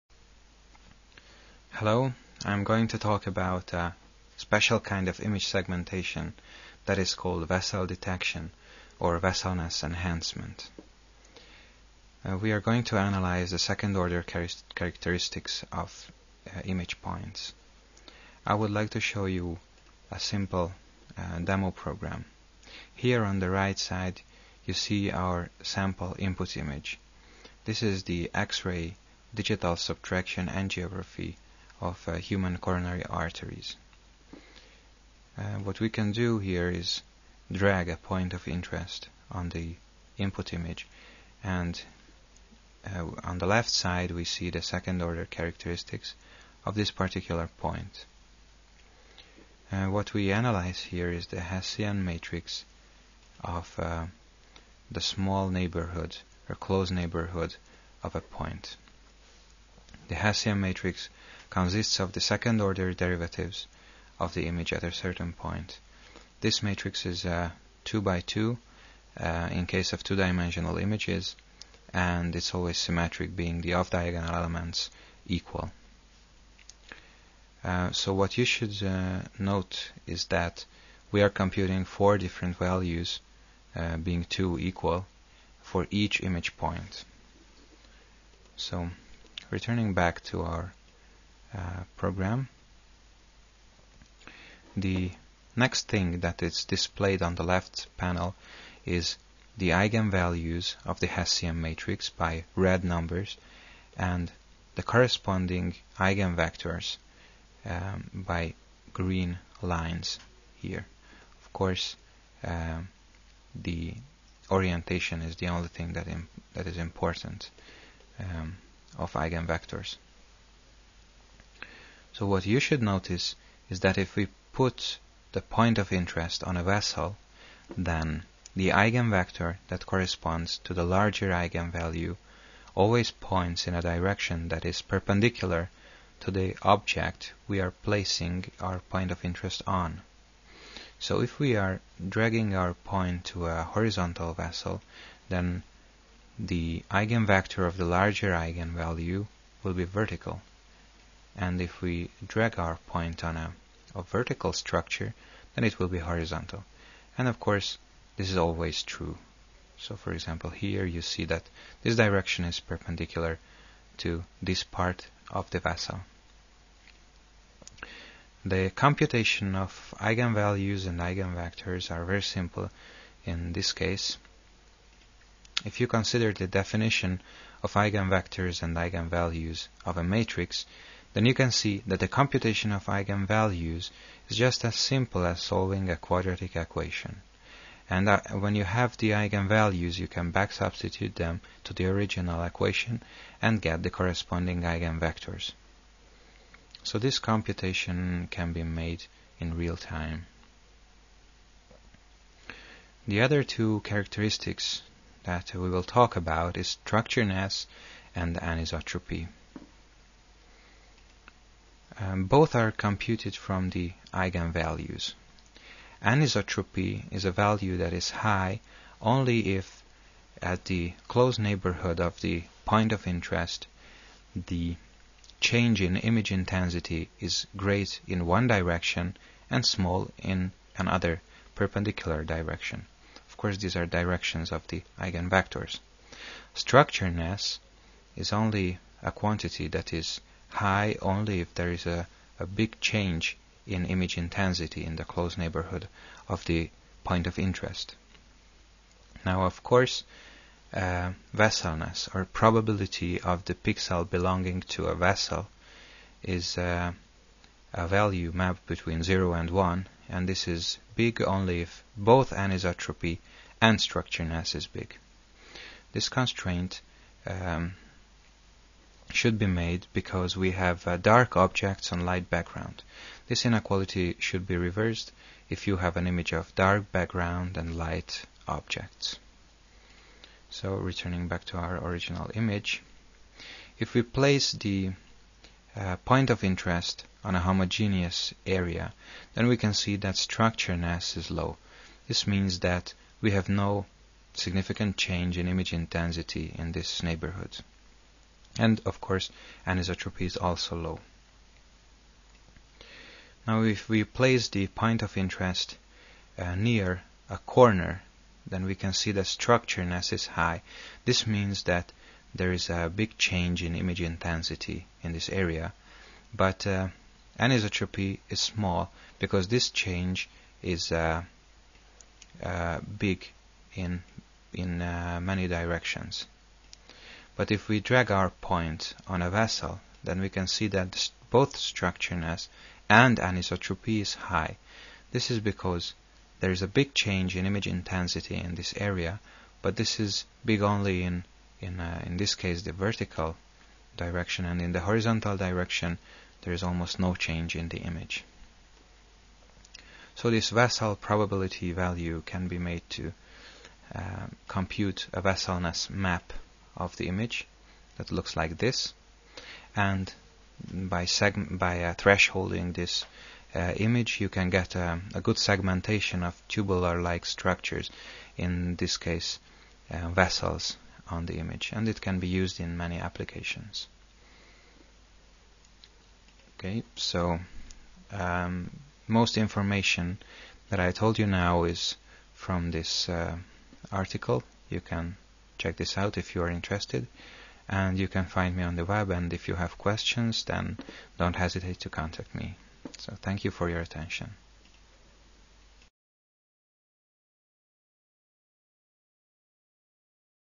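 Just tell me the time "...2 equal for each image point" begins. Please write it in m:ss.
1:24.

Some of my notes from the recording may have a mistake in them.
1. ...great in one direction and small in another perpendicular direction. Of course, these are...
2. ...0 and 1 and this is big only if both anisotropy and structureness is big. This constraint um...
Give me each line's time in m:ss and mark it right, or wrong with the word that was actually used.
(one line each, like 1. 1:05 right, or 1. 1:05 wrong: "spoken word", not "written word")
1. 3:47 right
2. 4:19 right.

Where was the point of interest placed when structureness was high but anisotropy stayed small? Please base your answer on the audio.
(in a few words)
near a corner.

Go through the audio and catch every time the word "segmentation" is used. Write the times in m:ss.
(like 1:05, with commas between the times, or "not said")
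0:05, 6:05.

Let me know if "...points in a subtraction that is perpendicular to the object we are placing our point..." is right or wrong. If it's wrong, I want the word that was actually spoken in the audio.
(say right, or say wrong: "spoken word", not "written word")
wrong: "direction", not "subtraction".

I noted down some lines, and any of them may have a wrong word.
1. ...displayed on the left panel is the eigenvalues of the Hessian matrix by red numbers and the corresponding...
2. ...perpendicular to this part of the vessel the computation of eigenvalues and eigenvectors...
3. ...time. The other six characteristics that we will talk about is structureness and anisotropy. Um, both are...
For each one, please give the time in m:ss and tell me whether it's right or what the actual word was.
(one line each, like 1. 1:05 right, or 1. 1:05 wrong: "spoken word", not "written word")
1. 1:36 right
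2. 2:42 right
3. 3:19 wrong: "two", not "six".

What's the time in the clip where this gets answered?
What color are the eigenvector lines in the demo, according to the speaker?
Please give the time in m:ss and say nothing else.
1:48.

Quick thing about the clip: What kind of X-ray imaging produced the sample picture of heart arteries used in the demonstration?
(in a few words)
digital subtraction angiography.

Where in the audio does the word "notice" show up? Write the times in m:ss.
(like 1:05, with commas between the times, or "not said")
2:02.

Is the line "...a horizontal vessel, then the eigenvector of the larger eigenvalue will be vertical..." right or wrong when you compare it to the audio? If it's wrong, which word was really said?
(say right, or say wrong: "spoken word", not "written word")
right.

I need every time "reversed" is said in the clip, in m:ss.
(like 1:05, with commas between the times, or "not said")
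4:34.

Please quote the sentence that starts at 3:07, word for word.
And uh, when you have the eigenvalues, you can back substitute them to the original equation and get the corresponding eigenvectors.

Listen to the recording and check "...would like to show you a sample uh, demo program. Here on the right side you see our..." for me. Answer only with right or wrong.
wrong.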